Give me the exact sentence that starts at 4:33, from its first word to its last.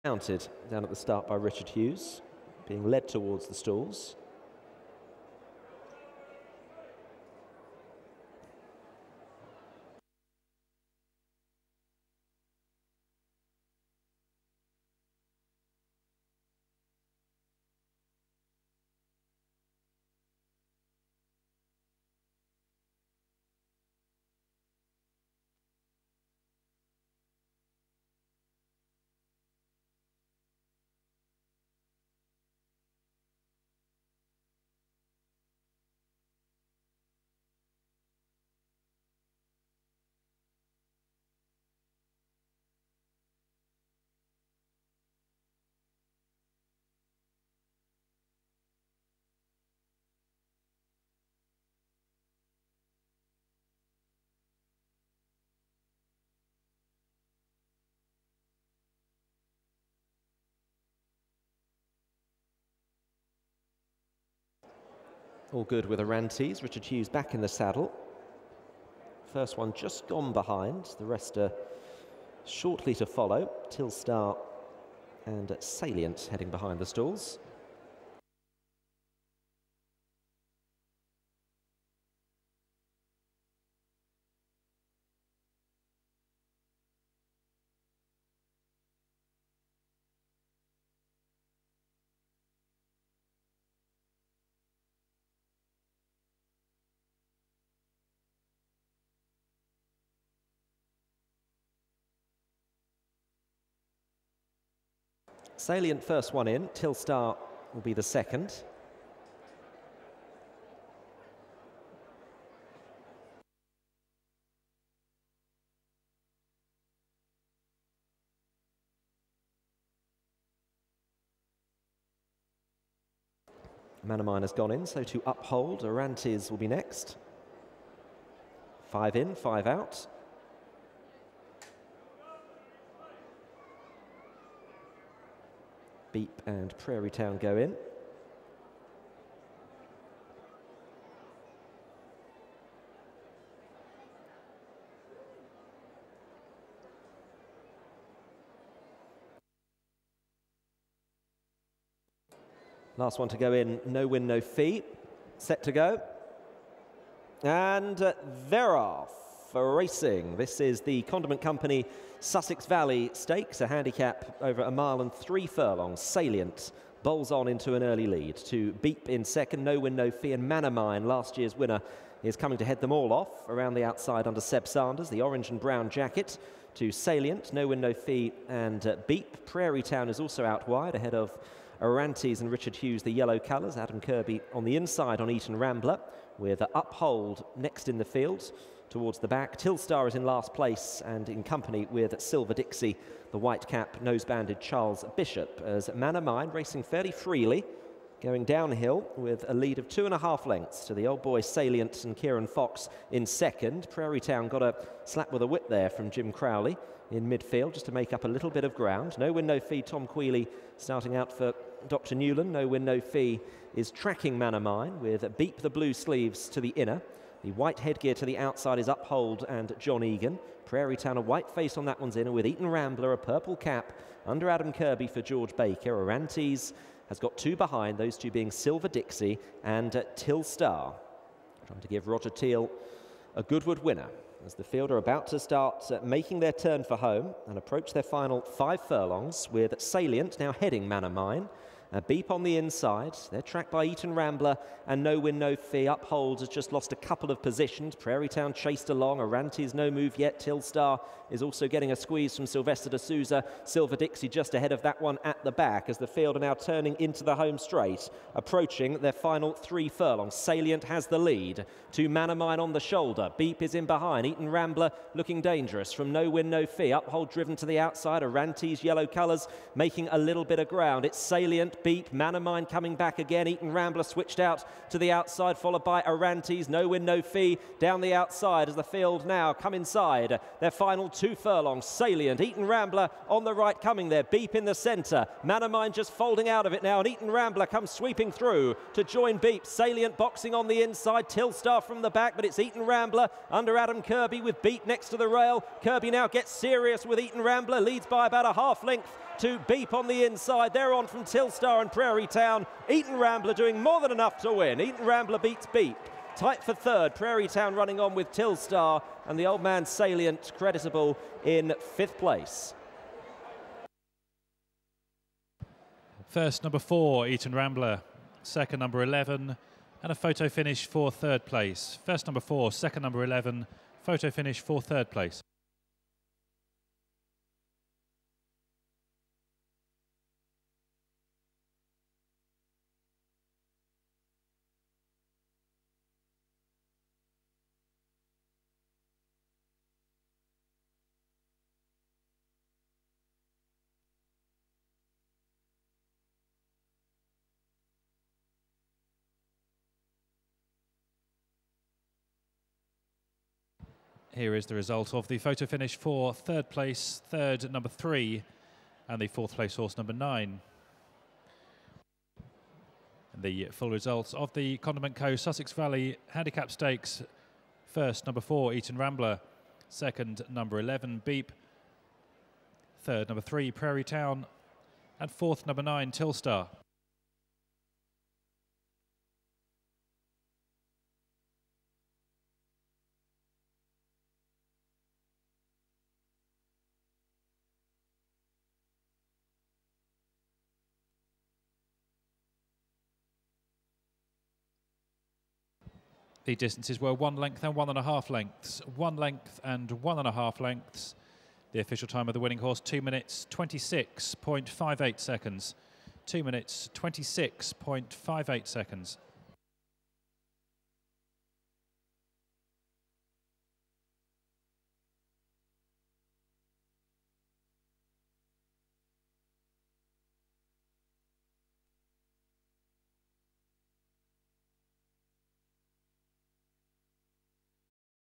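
Eton Rambler switched out to the outside, followed by Arantes.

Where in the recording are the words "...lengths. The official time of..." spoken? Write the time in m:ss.
6:40.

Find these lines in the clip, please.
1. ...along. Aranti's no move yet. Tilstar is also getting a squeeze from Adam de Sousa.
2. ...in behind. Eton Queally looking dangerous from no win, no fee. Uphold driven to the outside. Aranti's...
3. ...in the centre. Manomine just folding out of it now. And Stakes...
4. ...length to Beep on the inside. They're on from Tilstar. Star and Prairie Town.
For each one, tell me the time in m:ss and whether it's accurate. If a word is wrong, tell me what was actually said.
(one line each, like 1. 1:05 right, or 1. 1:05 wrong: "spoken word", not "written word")
1. 4:08 wrong: "Silvestre", not "Adam"
2. 4:23 wrong: "Rambler", not "Queally"
3. 4:44 wrong: "Eton", not "Stakes"
4. 4:58 right.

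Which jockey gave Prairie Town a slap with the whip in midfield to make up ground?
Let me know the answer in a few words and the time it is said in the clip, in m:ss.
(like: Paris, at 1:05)
Jim Crowley, at 3:26.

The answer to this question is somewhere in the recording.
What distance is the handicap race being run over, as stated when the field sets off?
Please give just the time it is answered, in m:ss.
2:44.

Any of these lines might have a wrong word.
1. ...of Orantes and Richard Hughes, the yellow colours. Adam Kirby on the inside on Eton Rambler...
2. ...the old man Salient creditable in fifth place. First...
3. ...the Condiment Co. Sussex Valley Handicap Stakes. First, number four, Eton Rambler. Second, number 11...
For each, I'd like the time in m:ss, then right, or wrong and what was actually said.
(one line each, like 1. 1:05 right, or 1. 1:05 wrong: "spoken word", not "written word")
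1. 3:01 right
2. 5:09 right
3. 6:04 right.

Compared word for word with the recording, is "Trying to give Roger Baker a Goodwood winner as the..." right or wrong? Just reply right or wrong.
wrong.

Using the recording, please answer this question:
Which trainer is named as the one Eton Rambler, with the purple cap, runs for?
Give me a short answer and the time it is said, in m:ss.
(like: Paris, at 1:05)
George Baker, at 3:45.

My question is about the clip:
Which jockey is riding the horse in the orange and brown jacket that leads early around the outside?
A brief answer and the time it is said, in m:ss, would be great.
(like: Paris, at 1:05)
Seb Sanders, at 2:54.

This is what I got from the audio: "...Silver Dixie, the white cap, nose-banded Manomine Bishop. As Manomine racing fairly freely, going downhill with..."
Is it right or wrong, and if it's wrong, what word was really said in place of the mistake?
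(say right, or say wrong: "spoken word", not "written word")
wrong: "Charles", not "Manomine".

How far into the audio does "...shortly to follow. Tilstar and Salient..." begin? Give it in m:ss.
1:12.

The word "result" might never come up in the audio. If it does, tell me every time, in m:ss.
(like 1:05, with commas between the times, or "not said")
5:54, 6:03.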